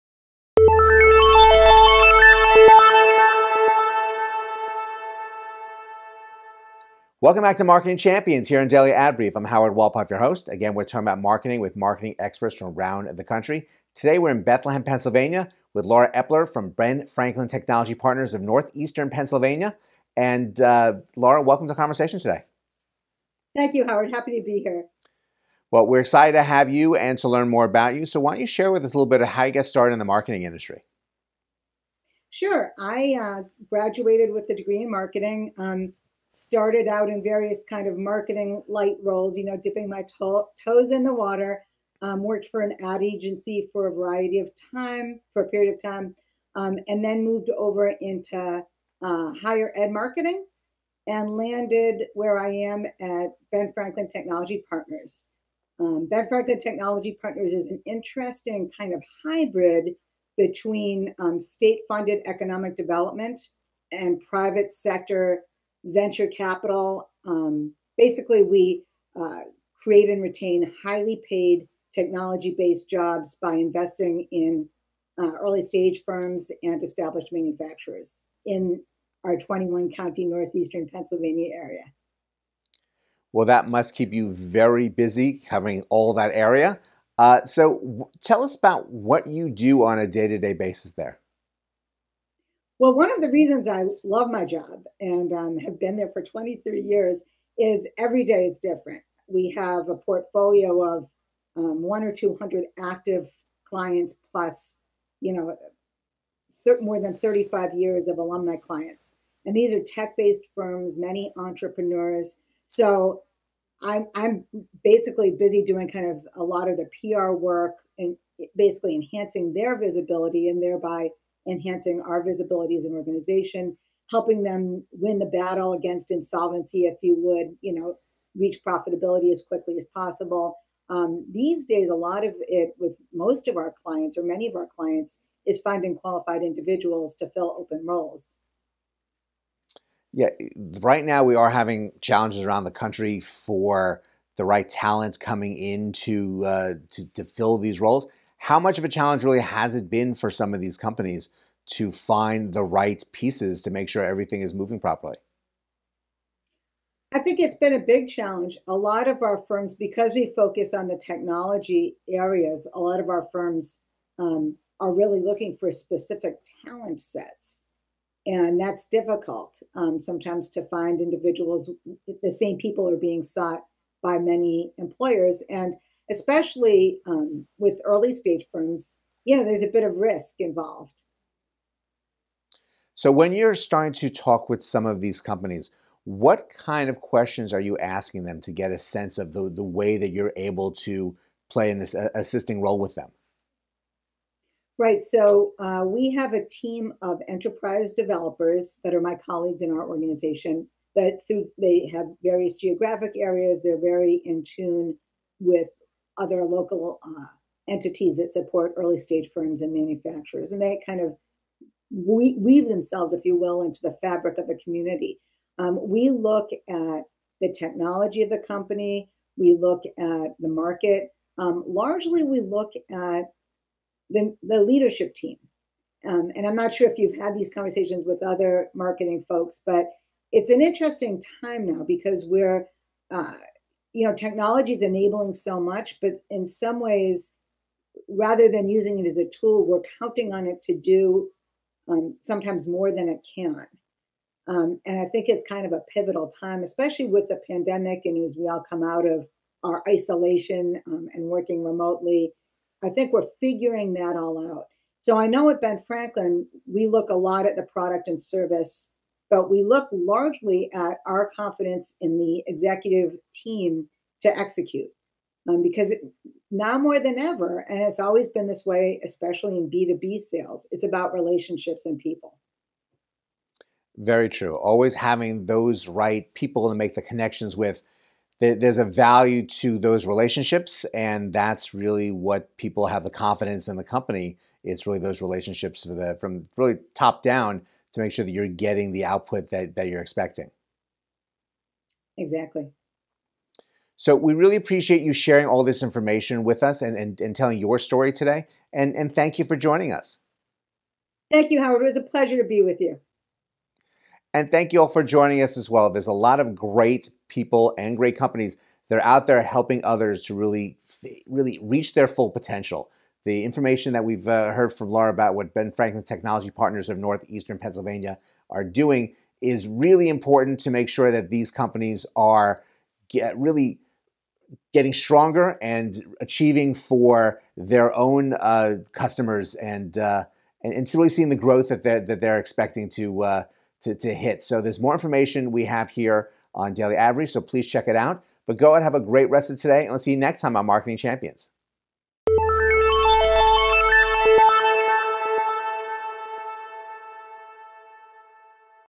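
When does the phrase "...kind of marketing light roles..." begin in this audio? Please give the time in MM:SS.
00:37.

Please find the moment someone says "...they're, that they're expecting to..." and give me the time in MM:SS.
05:31.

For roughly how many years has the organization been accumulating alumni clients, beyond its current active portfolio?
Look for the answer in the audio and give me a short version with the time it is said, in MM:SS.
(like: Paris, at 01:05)
35 years, at 01:47.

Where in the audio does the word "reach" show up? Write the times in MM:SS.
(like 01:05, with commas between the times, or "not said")
02:08, 05:11.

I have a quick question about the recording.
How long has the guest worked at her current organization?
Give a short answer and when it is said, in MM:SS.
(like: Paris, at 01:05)
23 years, at 01:36.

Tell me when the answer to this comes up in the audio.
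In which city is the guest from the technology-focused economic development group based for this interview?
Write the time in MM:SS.
00:14.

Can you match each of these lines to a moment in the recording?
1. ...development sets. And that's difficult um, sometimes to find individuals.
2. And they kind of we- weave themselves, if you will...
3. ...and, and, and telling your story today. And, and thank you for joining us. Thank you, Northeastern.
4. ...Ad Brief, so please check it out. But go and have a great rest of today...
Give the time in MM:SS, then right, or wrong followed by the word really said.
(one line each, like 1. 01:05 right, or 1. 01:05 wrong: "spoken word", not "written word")
1. 02:46 wrong: "talent", not "development"
2. 03:30 right
3. 04:56 wrong: "Howard", not "Northeastern"
4. 05:36 right.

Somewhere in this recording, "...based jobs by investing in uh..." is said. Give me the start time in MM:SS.
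01:12.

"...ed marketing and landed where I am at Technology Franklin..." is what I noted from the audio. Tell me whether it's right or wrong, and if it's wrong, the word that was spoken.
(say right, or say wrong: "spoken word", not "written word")
wrong: "Ben", not "Technology".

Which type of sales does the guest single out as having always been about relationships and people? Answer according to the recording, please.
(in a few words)
B2B sales.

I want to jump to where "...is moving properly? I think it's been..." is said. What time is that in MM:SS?
02:34.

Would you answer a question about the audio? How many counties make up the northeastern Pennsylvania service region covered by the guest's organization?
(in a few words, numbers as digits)
21.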